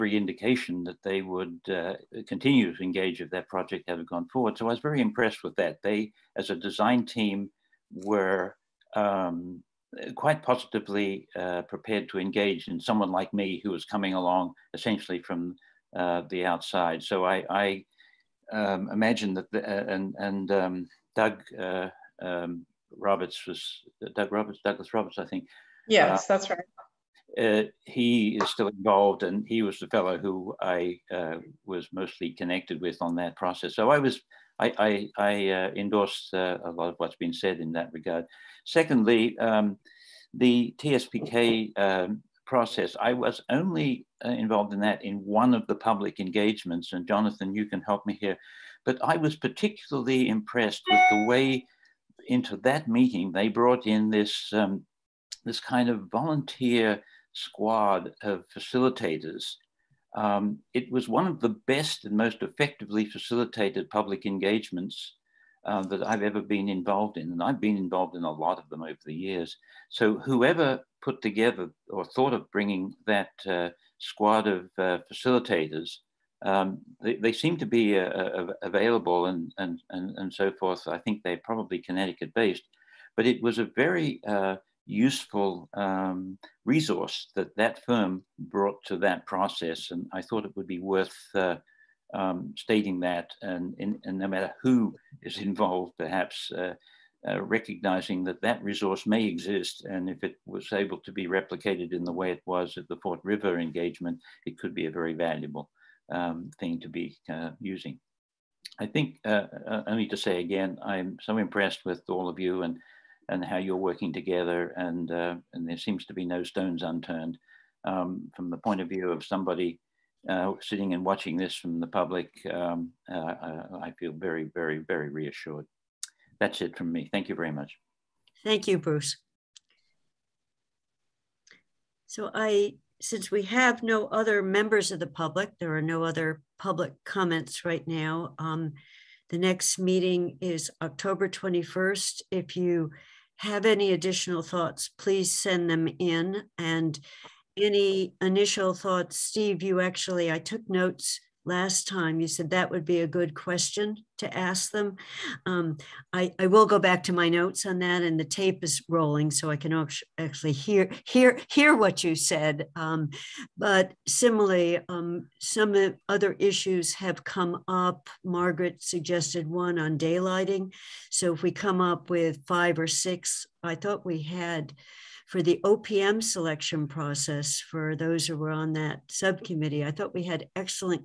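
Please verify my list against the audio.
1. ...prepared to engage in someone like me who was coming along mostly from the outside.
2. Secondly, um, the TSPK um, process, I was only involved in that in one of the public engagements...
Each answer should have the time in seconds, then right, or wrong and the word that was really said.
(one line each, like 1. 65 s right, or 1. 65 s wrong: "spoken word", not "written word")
1. 11 s wrong: "essentially", not "mostly"
2. 38 s right.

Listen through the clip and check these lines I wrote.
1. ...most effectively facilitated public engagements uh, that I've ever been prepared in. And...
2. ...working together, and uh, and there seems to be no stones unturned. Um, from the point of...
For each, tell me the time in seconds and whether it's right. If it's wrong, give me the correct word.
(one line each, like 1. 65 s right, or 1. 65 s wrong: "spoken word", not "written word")
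1. 62 s wrong: "involved", not "prepared"
2. 113 s right.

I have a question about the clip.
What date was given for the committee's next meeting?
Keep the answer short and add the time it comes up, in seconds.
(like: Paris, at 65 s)
October 21, at 140 s.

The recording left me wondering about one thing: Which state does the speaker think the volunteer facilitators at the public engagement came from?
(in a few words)
Connecticut.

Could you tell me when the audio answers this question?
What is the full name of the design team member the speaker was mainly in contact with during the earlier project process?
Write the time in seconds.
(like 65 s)
24 s.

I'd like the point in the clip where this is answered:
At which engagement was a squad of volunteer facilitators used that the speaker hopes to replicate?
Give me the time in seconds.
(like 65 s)
103 s.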